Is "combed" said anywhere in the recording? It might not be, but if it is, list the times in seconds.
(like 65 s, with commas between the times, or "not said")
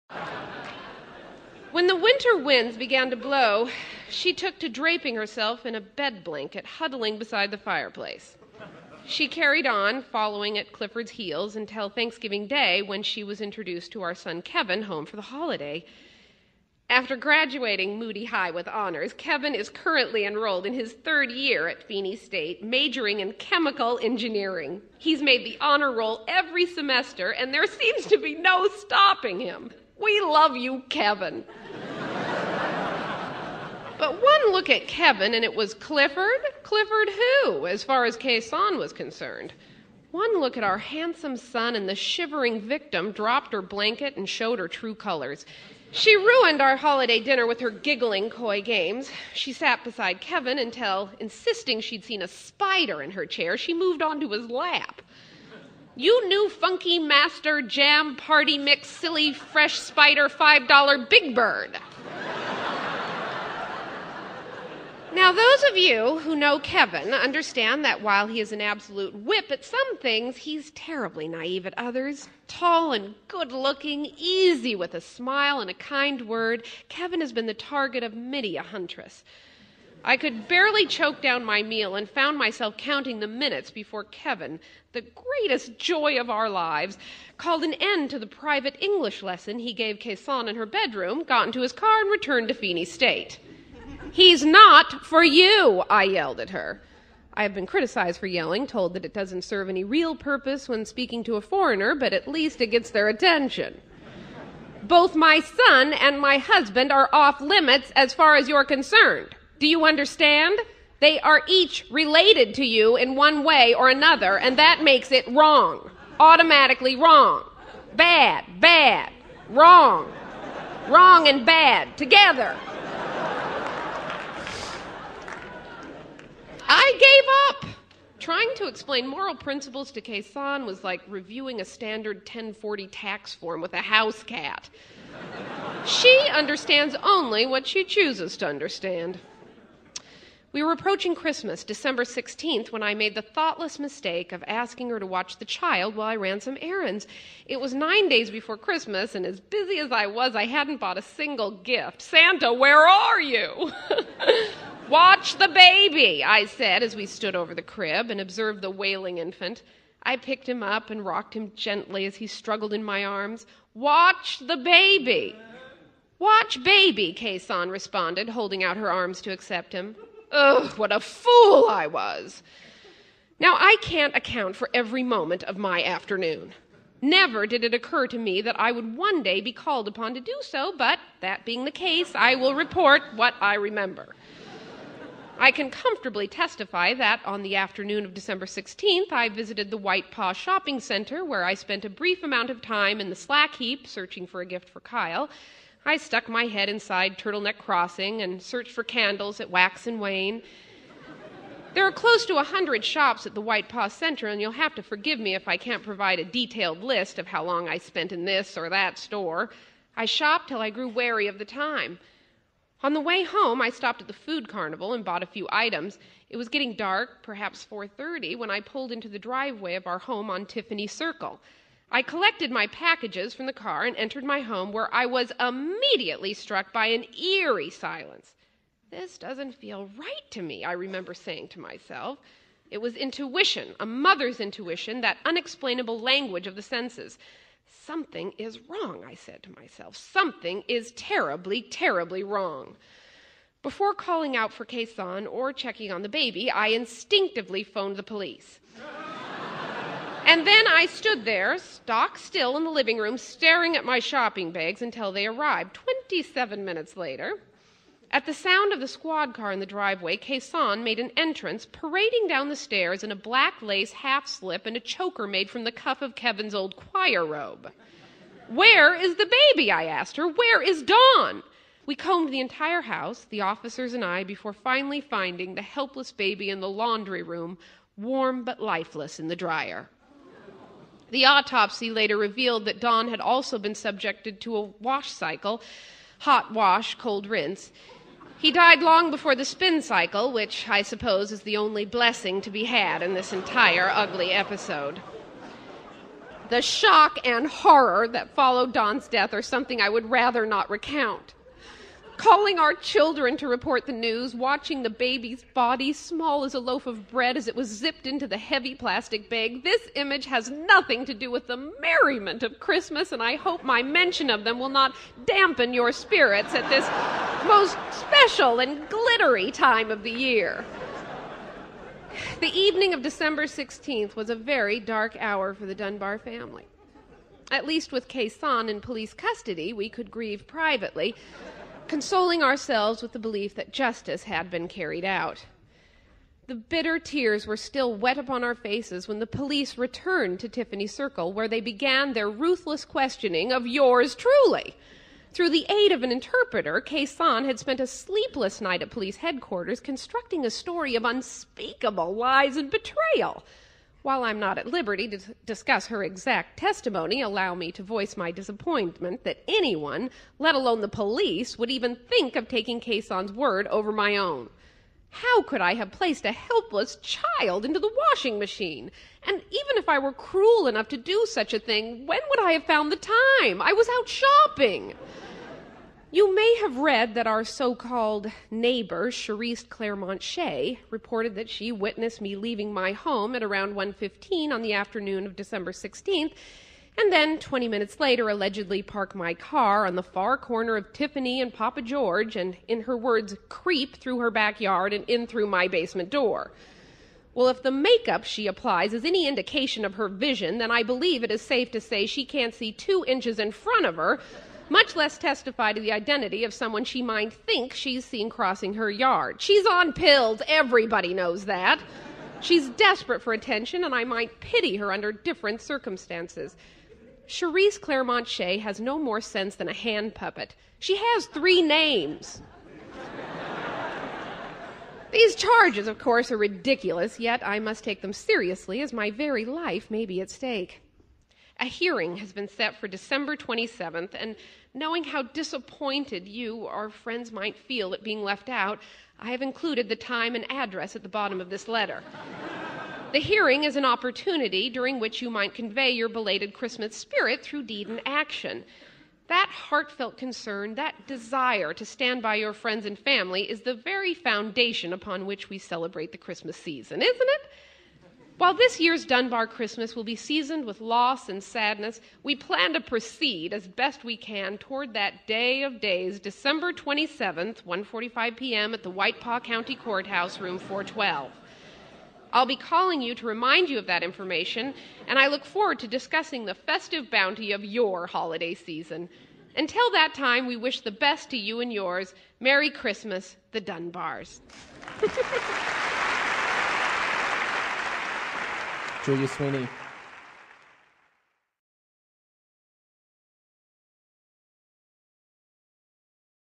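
271 s.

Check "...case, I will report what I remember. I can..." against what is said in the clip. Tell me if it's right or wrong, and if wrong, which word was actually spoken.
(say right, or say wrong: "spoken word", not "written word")
right.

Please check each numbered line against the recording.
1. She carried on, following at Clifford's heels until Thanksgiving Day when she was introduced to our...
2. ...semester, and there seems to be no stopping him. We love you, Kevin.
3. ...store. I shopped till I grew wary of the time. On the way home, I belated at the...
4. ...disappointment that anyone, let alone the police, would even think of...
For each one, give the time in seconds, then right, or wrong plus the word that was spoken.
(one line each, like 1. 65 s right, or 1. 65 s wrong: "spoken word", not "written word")
1. 9 s right
2. 26 s right
3. 208 s wrong: "stopped", not "belated"
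4. 358 s right.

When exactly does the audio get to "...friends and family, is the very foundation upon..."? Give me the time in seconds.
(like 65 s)
452 s.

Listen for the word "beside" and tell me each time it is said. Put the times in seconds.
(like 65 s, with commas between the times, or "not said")
7 s, 49 s.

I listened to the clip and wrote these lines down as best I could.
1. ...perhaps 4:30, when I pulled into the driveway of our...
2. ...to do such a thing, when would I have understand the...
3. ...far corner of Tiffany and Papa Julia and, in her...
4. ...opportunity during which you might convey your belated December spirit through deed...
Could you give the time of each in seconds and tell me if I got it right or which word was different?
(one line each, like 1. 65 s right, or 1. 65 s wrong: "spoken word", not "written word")
1. 217 s right
2. 370 s wrong: "found", not "understand"
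3. 390 s wrong: "George", not "Julia"
4. 443 s wrong: "Christmas", not "December".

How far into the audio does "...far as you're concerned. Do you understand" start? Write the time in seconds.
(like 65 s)
108 s.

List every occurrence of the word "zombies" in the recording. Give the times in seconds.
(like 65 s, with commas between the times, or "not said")
not said.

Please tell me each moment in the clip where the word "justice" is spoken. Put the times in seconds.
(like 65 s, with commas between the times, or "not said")
333 s.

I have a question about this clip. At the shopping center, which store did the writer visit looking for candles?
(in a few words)
Wax and Wane.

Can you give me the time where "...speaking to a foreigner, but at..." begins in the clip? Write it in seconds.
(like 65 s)
100 s.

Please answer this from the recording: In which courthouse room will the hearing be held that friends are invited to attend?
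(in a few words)
412.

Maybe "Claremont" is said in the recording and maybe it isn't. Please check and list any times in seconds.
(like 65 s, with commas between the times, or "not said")
379 s, 417 s.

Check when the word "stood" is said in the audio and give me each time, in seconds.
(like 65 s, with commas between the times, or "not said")
157 s, 250 s.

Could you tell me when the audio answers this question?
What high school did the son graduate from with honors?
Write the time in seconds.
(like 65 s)
17 s.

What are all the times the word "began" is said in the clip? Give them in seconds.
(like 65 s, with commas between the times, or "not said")
2 s, 341 s.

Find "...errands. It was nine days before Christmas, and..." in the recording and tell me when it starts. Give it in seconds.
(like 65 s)
146 s.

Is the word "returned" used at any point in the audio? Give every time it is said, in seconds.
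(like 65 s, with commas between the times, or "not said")
92 s, 339 s.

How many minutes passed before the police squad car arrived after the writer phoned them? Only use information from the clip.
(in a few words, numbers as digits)
27.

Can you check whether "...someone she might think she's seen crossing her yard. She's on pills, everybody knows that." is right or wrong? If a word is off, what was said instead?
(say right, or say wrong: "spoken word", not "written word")
right.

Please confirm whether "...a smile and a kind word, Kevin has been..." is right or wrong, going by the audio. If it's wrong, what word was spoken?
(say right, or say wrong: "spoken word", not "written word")
right.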